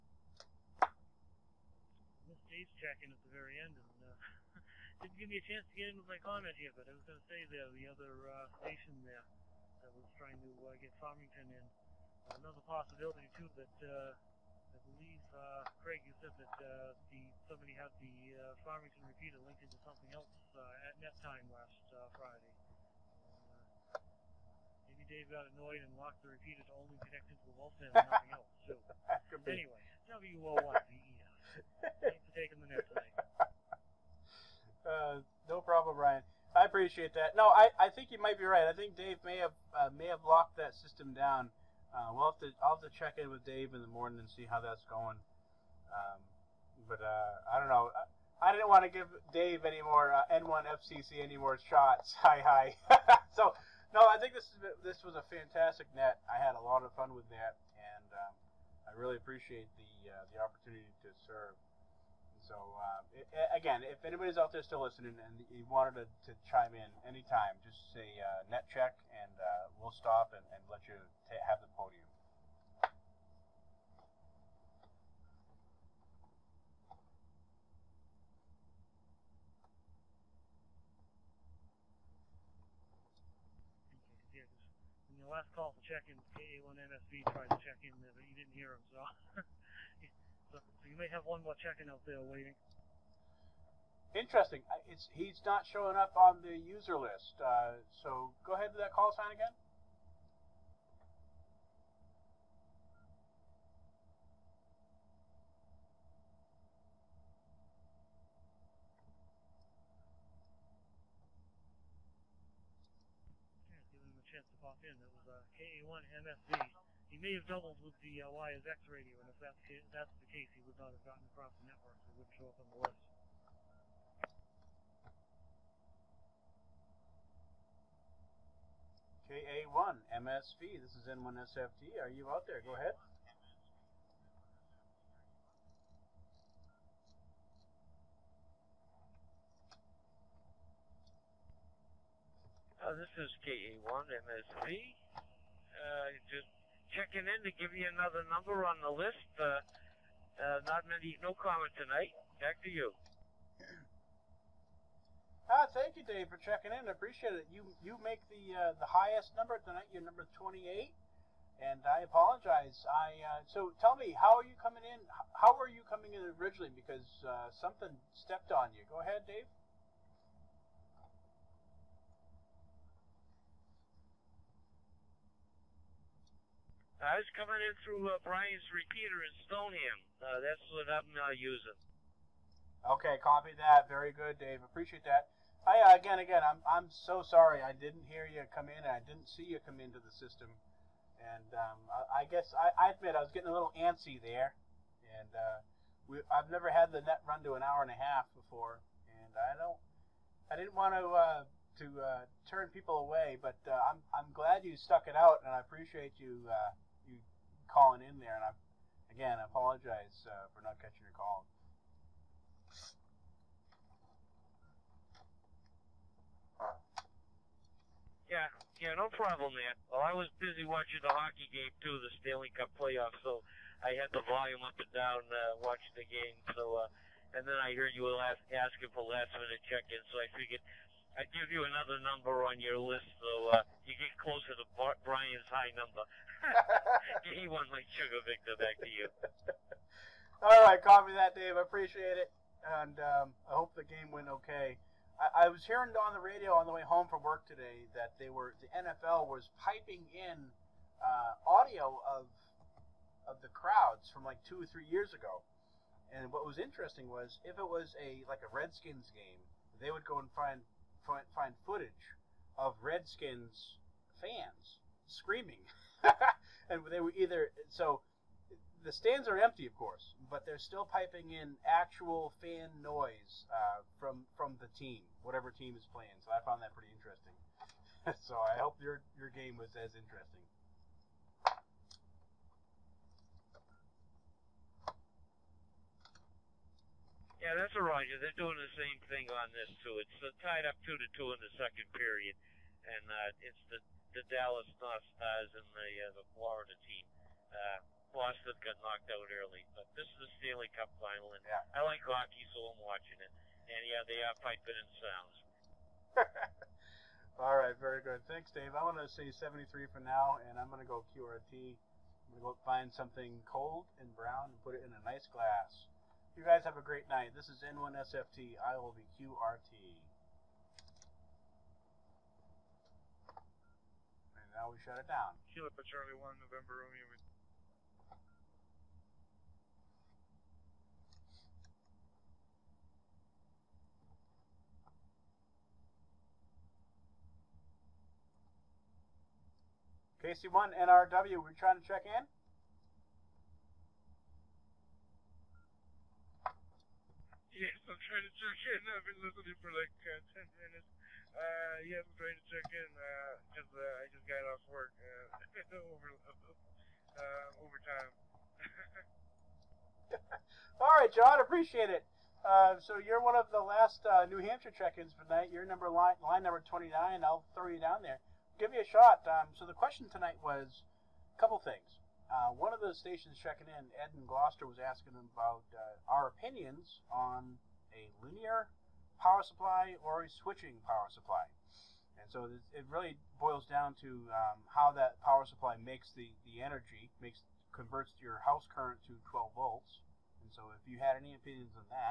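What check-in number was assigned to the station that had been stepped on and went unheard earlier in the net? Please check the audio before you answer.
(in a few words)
28.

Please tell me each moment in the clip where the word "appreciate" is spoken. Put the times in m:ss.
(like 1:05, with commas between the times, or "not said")
0:36, 0:59, 2:36, 3:04, 3:25, 4:01, 6:01.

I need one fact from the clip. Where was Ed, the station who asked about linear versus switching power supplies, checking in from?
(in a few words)
Gloucester.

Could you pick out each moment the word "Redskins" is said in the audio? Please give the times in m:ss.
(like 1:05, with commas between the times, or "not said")
4:18, 4:22.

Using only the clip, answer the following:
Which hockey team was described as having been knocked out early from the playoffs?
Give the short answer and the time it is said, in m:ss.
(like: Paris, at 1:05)
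Boston, at 4:58.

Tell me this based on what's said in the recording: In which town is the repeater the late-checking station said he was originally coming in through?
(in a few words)
Stoneham.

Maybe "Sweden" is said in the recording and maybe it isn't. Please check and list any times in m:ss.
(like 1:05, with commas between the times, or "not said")
not said.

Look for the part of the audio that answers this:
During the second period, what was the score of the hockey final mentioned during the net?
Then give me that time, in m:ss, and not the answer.
4:50.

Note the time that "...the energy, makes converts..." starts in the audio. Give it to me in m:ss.
6:26.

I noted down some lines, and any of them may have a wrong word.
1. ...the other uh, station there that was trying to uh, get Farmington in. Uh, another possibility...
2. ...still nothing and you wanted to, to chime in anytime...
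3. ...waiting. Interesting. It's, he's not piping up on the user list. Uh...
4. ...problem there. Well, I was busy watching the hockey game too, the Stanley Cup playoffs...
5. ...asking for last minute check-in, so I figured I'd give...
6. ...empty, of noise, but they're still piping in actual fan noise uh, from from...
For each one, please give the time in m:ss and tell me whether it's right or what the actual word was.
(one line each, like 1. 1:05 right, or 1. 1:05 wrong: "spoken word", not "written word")
1. 0:07 right
2. 1:04 wrong: "listening", not "nothing"
3. 1:32 wrong: "showing", not "piping"
4. 3:39 right
5. 3:48 right
6. 4:29 wrong: "course", not "noise".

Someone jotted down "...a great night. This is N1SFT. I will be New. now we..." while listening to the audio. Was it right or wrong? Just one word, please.
wrong.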